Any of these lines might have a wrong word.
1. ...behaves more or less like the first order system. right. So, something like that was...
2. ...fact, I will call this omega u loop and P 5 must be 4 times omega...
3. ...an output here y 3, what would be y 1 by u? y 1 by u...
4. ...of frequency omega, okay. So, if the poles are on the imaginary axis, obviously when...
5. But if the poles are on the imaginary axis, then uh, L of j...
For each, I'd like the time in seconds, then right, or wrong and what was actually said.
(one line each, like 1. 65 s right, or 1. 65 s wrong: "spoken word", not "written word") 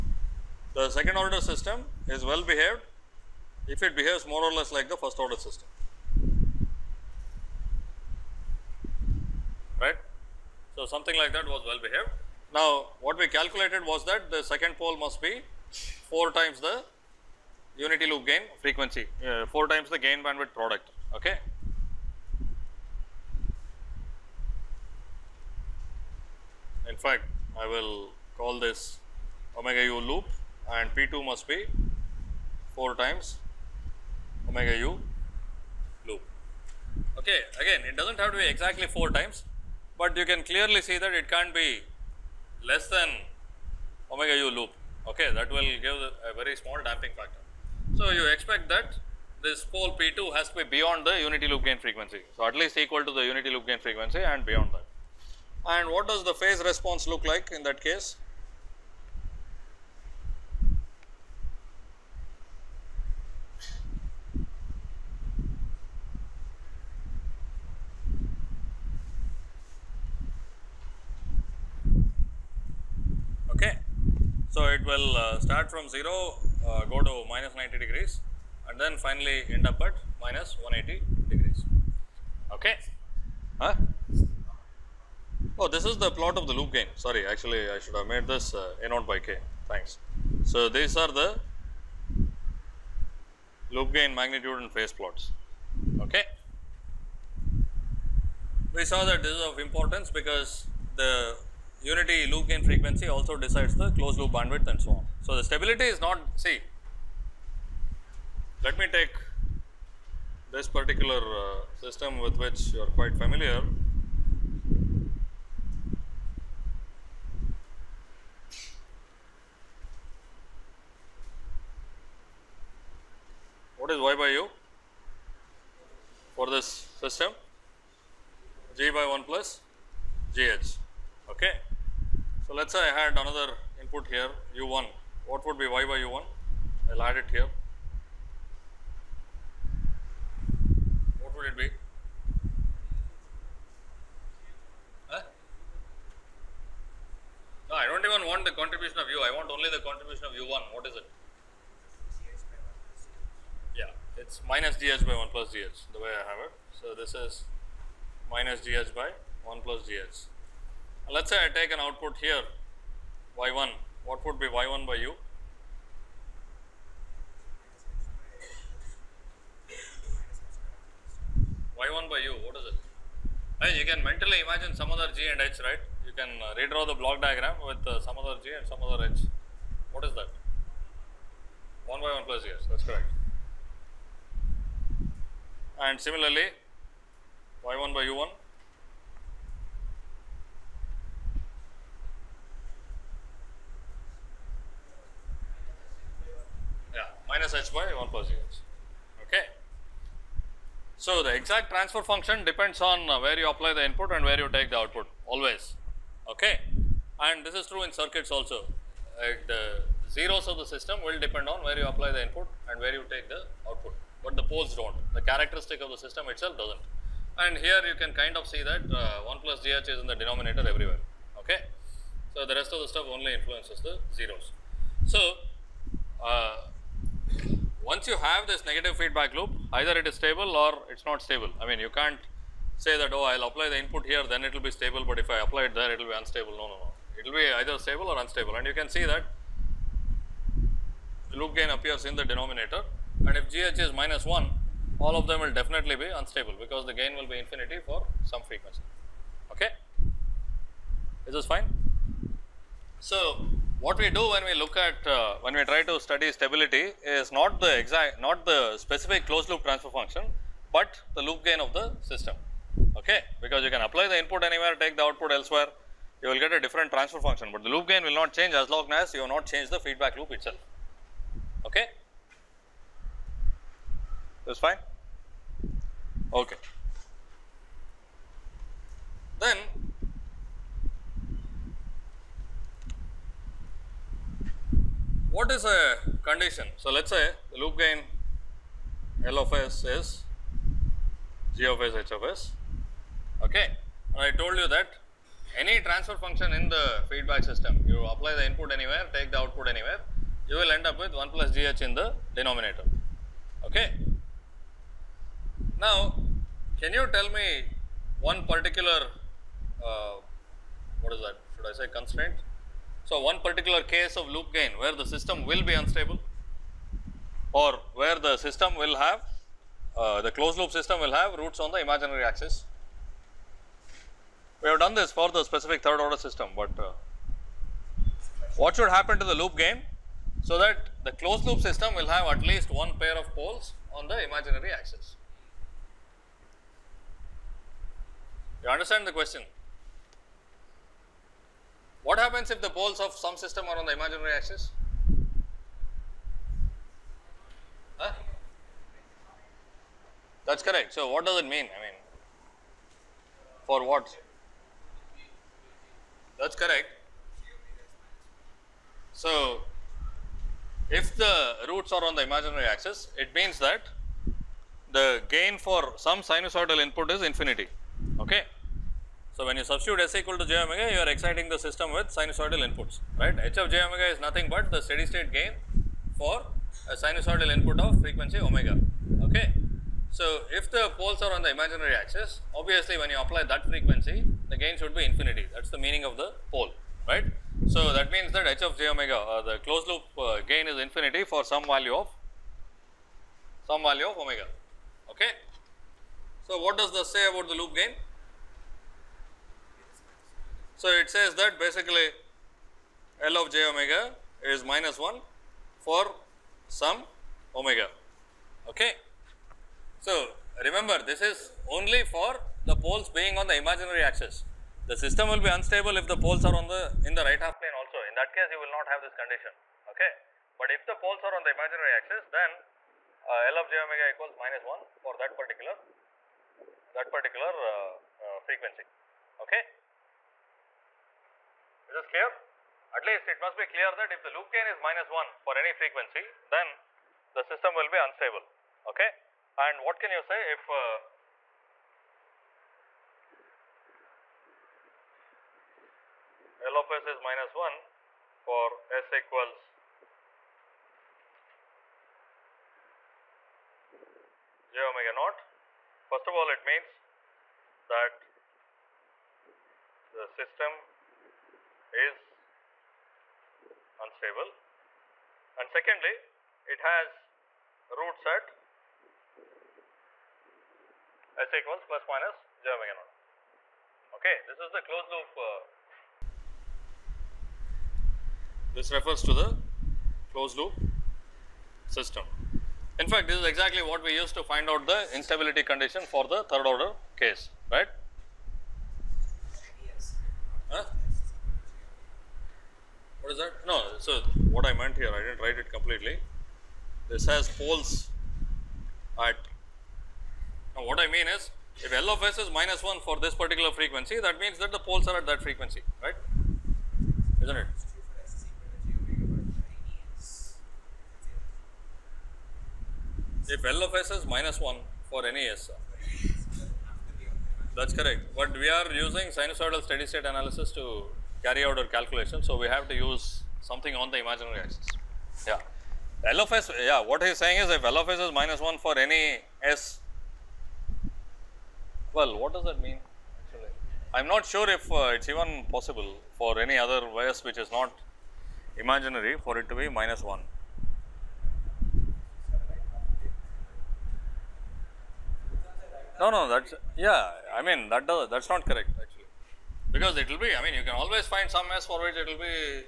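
1. 3 s right
2. 27 s wrong: "2", not "5"
3. 161 s wrong: "1", not "3"
4. 377 s right
5. 420 s right.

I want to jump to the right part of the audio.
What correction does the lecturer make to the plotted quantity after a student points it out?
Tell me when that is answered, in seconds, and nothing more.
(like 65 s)
88 s.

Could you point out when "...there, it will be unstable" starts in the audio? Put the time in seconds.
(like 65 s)
235 s.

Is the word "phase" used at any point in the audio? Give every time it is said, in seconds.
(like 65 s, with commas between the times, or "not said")
56 s, 94 s.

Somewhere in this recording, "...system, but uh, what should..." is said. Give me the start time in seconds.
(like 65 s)
326 s.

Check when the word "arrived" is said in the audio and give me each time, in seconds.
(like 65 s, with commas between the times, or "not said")
not said.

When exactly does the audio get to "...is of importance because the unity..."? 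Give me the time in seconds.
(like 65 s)
99 s.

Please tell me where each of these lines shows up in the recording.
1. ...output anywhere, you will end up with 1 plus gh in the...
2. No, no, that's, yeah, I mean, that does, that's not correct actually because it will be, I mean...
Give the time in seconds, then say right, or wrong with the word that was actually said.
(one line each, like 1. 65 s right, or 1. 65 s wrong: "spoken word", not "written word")
1. 299 s right
2. 546 s right.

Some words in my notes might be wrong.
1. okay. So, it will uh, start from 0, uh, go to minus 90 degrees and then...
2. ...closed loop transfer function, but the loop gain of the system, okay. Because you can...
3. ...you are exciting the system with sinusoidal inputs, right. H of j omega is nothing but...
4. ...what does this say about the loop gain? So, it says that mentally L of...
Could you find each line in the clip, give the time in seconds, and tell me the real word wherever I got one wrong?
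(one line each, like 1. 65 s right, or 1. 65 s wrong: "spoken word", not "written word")
1. 73 s right
2. 259 s right
3. 370 s right
4. 396 s wrong: "basically", not "mentally".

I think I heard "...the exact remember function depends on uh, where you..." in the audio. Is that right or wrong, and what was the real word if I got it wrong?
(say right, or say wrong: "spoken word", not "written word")
wrong: "transfer", not "remember".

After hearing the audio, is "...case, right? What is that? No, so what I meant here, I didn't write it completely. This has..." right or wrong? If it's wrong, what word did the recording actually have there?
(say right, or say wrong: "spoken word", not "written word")
right.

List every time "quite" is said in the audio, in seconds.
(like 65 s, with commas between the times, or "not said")
112 s.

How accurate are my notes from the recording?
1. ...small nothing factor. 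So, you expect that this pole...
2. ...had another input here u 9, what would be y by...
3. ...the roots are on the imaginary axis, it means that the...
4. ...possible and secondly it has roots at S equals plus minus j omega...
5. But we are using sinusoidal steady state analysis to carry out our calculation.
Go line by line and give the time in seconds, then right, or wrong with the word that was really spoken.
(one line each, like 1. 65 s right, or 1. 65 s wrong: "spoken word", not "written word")
1. 46 s wrong: "damping", not "nothing"
2. 133 s wrong: "1", not "9"
3. 361 s right
4. 463 s wrong: "unstable", not "possible"
5. 518 s right.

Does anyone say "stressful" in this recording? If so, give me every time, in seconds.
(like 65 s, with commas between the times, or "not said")
not said.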